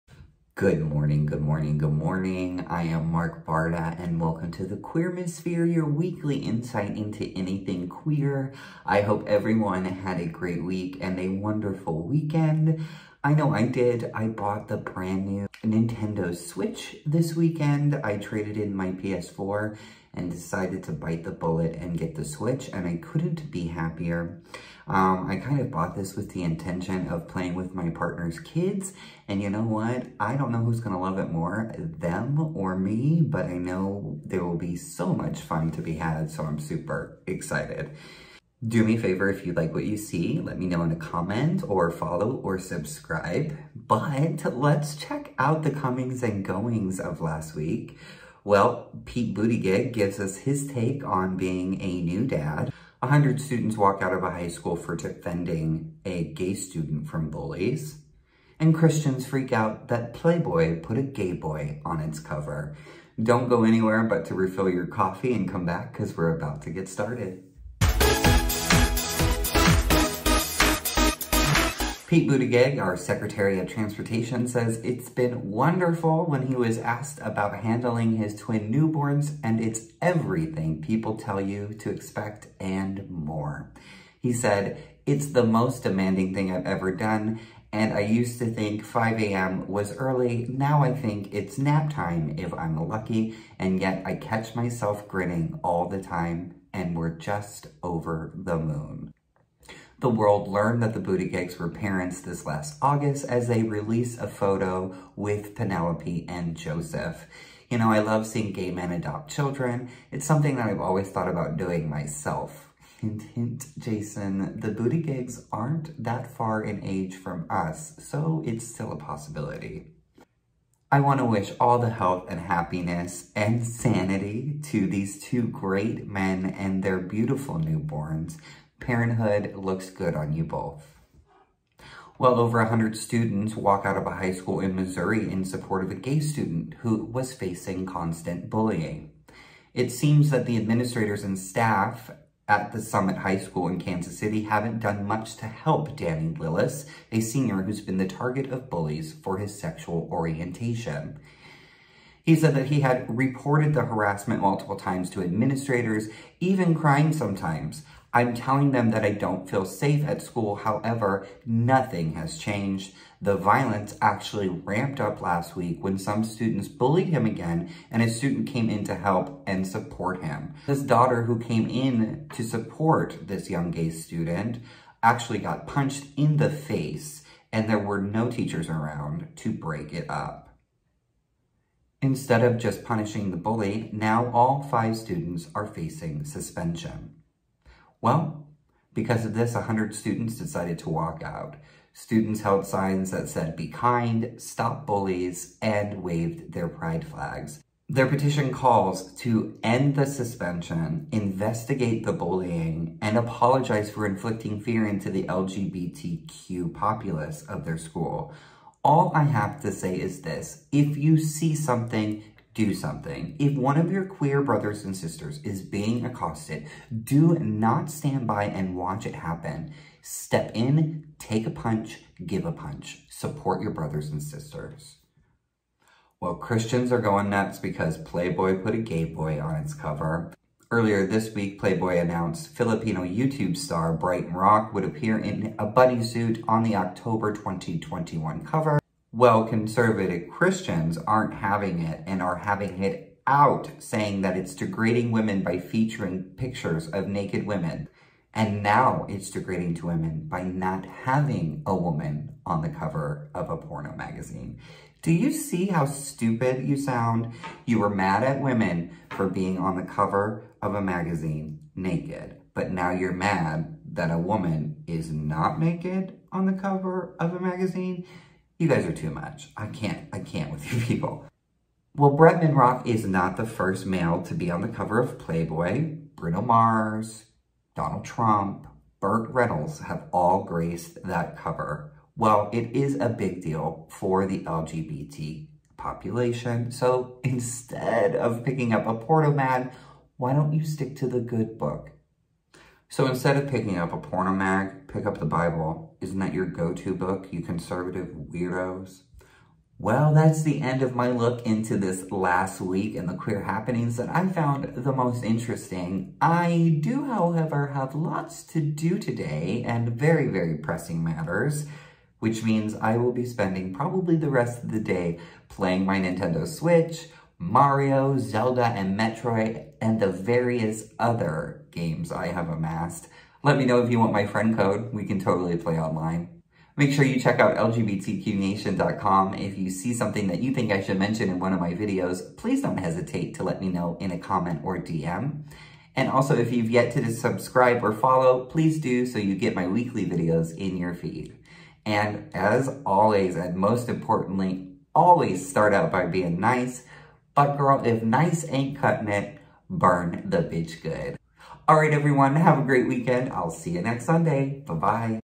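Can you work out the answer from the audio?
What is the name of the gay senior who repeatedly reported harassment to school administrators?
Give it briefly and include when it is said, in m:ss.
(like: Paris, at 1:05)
Danny Lillis, at 2:25.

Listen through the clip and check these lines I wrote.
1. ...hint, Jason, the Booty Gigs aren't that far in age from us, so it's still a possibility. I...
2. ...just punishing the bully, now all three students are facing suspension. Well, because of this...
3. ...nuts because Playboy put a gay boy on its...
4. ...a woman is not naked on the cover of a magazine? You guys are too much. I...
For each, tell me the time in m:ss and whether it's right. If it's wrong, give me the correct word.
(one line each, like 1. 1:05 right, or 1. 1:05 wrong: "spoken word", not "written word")
1. 1:53 right
2. 3:02 wrong: "five", not "three"
3. 3:47 right
4. 4:24 right.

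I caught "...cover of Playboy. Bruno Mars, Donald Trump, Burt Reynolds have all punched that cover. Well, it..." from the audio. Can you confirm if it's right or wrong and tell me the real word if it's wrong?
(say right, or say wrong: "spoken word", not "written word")
wrong: "graced", not "punched".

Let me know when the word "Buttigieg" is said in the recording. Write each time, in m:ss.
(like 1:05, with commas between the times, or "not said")
0:49, 1:12, 1:40.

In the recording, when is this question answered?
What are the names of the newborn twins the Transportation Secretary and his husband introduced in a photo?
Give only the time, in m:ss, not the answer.
1:45.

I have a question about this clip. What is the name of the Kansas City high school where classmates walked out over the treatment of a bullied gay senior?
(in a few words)
Summit High School.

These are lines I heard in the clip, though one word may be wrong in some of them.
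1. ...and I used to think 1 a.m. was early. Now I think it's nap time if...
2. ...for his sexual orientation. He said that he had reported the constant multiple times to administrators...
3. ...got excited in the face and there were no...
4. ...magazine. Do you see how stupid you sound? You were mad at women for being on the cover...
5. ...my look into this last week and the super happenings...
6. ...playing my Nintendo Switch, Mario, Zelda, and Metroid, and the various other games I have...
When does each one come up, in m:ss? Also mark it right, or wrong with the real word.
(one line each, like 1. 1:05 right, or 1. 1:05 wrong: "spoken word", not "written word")
1. 1:27 wrong: "5", not "1"
2. 2:29 wrong: "harassment", not "constant"
3. 2:55 wrong: "punched", not "excited"
4. 4:13 right
5. 5:00 wrong: "queer", not "super"
6. 5:15 right.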